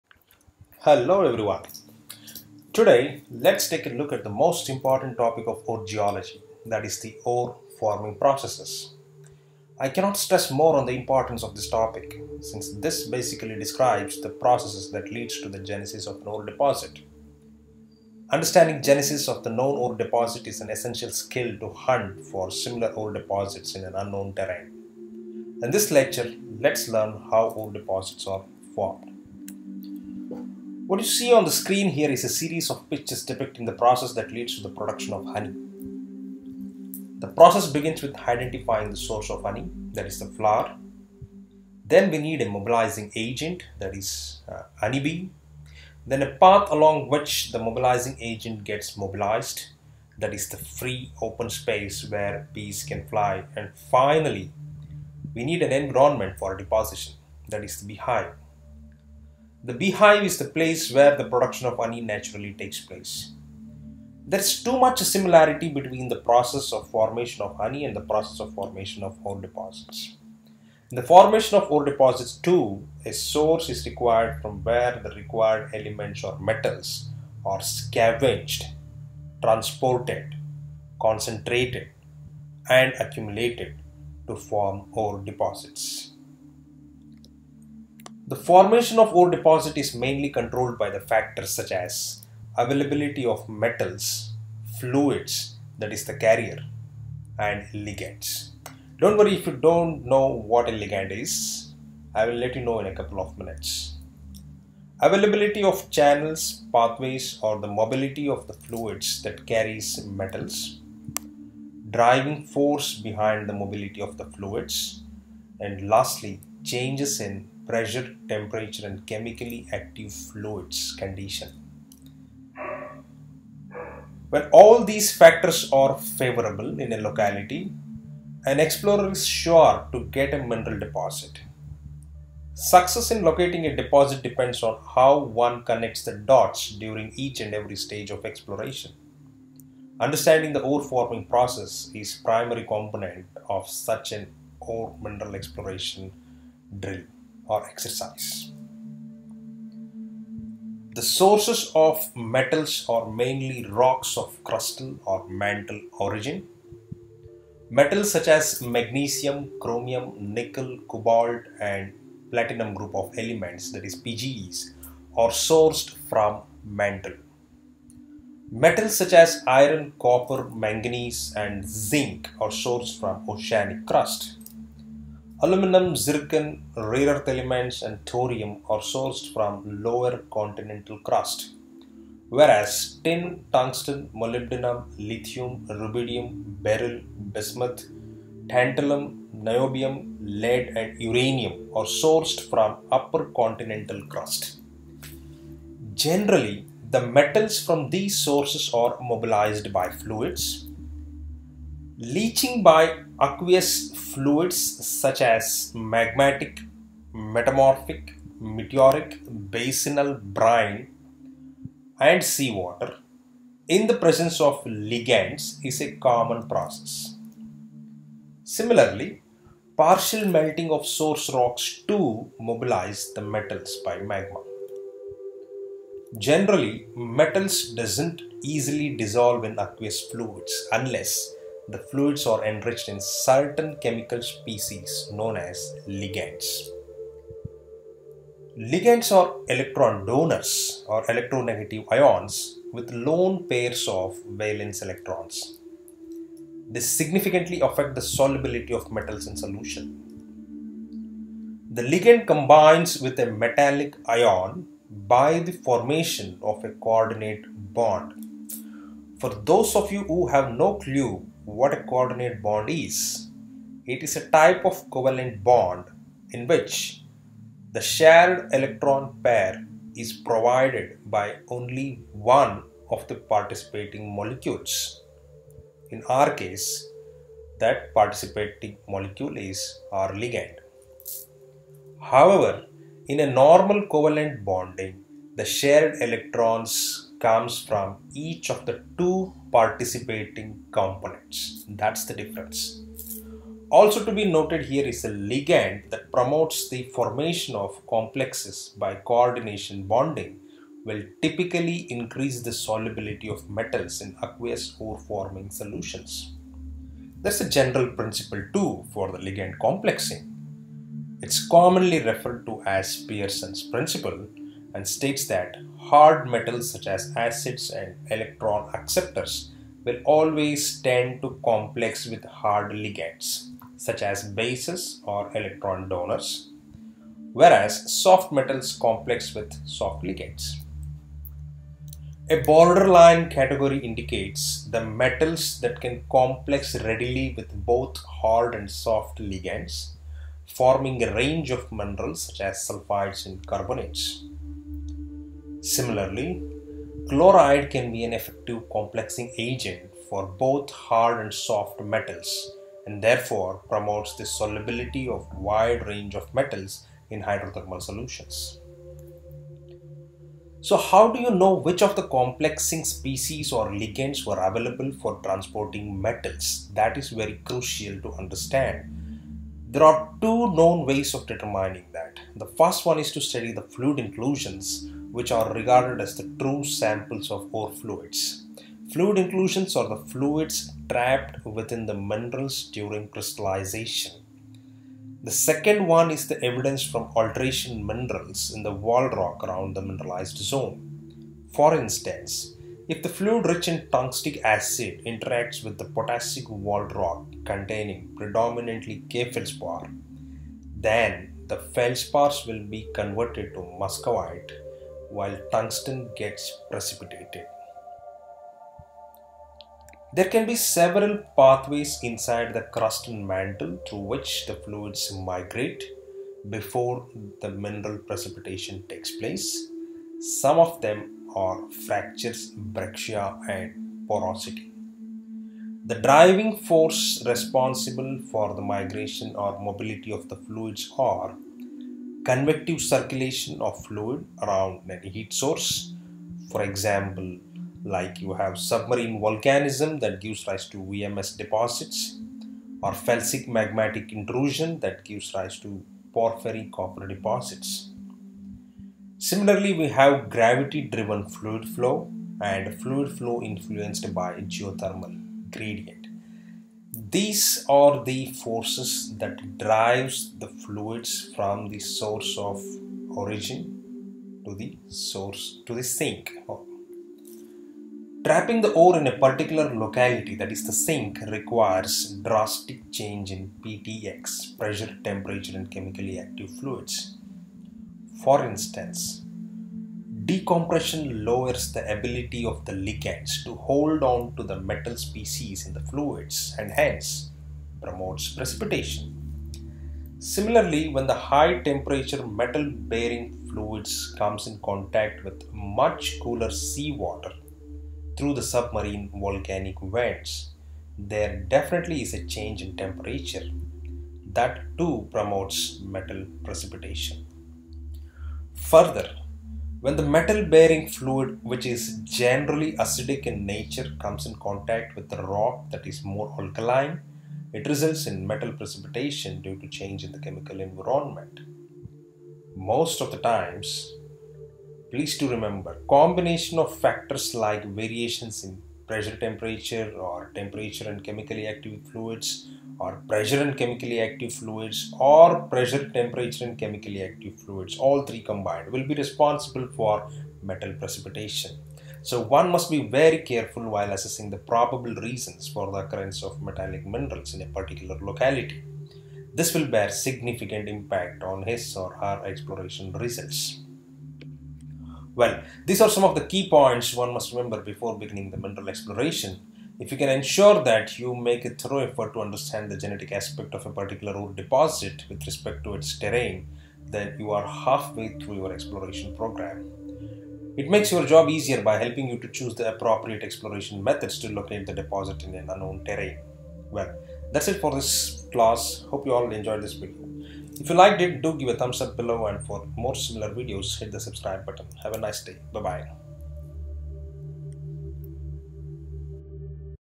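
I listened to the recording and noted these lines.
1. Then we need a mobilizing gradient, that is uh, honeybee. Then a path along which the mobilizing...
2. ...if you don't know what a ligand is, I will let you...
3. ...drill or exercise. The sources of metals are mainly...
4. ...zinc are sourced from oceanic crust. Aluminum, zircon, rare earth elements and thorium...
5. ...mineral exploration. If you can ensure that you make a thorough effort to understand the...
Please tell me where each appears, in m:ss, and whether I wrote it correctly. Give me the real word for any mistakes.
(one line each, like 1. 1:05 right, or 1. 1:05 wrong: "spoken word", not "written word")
1. 0:41 wrong: "agent", not "gradient"
2. 1:39 right
3. 2:26 right
4. 2:51 right
5. 9:18 right.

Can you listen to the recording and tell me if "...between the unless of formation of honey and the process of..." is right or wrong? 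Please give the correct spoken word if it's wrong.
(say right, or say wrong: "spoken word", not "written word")
wrong: "process", not "unless".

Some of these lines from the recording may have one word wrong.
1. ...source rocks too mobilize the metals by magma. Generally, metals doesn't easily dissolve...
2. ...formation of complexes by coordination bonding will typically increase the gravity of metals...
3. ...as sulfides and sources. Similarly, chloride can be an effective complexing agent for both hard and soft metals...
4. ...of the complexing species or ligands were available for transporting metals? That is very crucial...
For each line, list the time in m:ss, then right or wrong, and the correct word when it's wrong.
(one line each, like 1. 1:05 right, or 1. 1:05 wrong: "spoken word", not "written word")
1. 3:40 right
2. 4:56 wrong: "solubility", not "gravity"
3. 5:42 wrong: "carbonates", not "sources"
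4. 6:01 right.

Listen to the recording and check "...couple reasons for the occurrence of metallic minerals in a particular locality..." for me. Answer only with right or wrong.
wrong.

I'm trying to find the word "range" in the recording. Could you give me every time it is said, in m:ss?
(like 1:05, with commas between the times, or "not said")
5:41, 5:55.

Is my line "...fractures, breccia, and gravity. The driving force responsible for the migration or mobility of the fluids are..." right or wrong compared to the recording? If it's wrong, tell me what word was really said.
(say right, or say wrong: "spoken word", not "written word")
wrong: "porosity", not "gravity".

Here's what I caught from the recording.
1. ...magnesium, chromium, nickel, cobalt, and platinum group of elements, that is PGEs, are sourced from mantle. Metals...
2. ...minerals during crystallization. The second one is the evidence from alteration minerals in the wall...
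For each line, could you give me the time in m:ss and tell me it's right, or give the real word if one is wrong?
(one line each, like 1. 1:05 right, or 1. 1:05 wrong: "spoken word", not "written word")
1. 2:38 right
2. 6:21 right.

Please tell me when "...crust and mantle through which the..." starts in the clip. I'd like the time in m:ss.
6:52.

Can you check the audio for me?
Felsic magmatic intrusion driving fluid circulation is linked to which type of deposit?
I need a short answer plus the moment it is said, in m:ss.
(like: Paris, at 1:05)
porphyry copper deposits, at 7:26.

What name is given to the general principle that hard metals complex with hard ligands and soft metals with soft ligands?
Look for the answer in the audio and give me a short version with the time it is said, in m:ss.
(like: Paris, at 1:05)
Pearson's principle, at 5:13.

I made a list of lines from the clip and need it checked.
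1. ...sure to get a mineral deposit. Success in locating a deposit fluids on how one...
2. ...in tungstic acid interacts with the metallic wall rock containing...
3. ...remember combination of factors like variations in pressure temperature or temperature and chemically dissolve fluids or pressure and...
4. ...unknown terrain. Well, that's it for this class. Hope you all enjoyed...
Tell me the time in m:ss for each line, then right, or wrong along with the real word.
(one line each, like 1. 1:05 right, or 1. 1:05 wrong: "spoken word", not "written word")
1. 2:09 wrong: "depends", not "fluids"
2. 6:33 wrong: "potassic", not "metallic"
3. 8:45 wrong: "active", not "dissolve"
4. 9:35 right.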